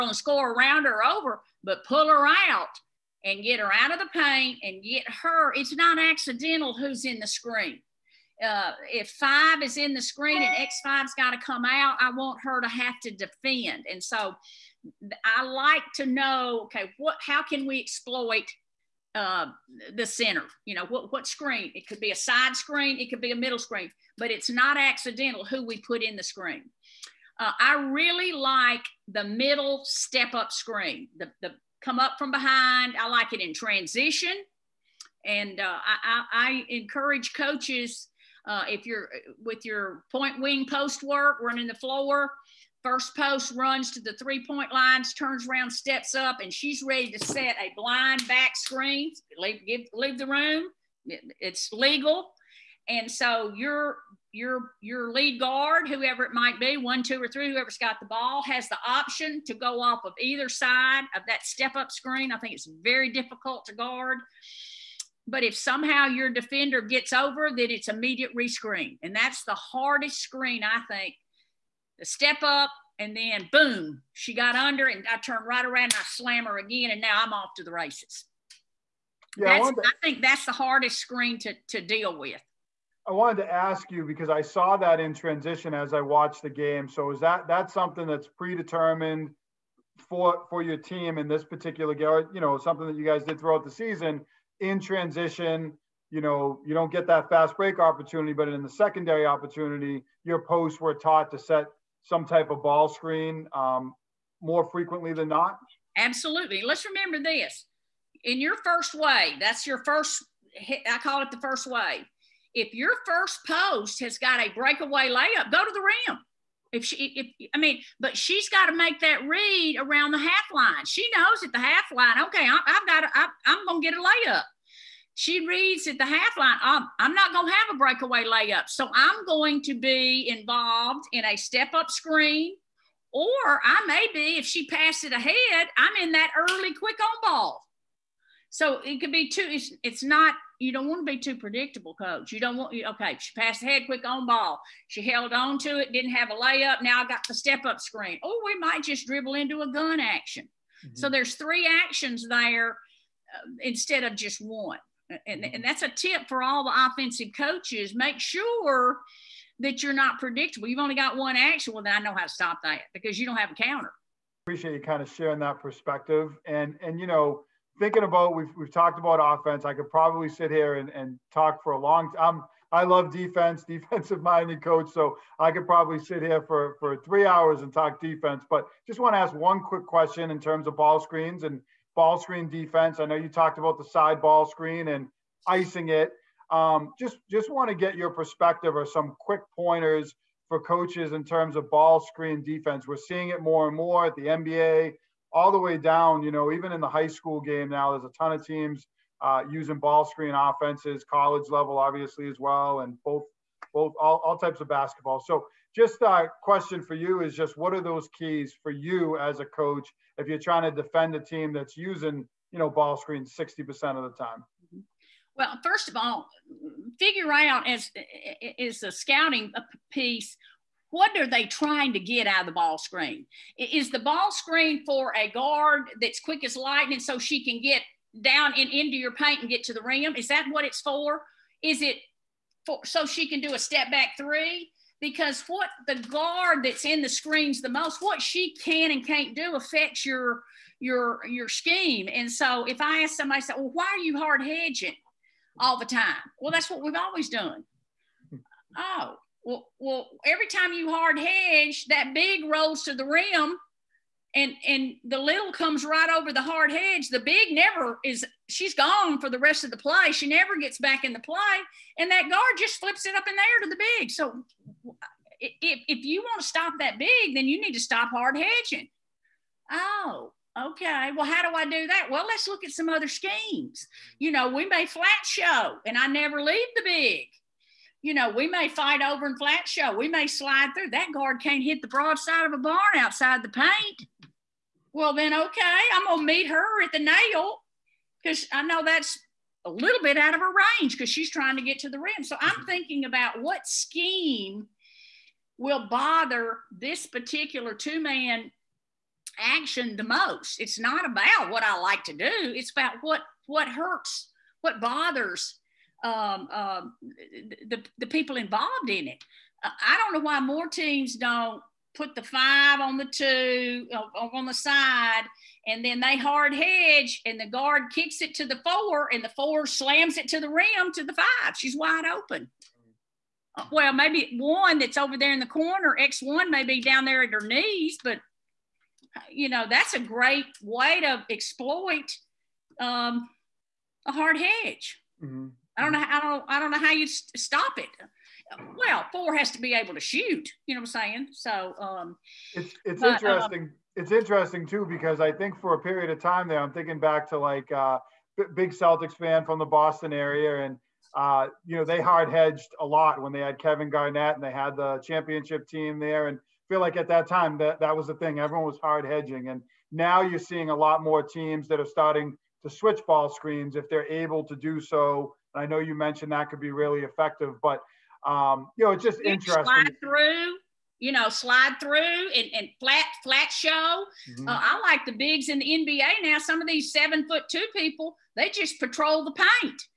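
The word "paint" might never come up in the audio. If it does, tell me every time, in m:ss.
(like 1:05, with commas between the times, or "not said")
0:04, 3:49, 4:43, 6:19.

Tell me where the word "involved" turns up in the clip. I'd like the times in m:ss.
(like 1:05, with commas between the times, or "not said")
2:10, 5:08.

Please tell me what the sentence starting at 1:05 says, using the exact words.
But if somehow your defender gets over, then it's immediate rescreen.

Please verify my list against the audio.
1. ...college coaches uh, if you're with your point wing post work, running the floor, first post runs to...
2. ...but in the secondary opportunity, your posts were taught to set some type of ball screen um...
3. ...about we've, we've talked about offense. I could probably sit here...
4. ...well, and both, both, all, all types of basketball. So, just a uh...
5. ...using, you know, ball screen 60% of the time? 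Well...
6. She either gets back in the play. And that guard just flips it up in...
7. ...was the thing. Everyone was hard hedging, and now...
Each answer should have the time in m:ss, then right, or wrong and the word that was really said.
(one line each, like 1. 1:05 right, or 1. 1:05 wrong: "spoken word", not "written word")
1. 0:36 wrong: "encourage", not "college"
2. 1:38 right
3. 2:48 right
4. 3:22 right
5. 3:31 right
6. 4:20 wrong: "never", not "either"
7. 5:57 right.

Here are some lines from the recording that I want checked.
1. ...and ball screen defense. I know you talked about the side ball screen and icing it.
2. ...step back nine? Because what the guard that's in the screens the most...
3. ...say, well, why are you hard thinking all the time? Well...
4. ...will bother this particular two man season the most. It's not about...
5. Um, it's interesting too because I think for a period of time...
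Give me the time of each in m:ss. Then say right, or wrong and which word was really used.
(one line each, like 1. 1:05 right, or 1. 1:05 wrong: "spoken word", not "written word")
1. 3:01 right
2. 3:53 wrong: "three", not "nine"
3. 4:03 wrong: "hedging", not "thinking"
4. 4:55 wrong: "action", not "season"
5. 5:43 right.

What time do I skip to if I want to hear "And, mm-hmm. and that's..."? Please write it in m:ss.
2:35.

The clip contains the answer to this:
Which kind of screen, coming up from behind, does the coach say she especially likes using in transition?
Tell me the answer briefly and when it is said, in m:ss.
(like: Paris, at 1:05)
Middle step up screen, at 0:29.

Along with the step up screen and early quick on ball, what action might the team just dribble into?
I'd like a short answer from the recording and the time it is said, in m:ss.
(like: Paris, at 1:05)
Gun action, at 2:29.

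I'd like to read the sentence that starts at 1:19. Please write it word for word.
Yeah, I, I think that's the hardest screen to, to deal with.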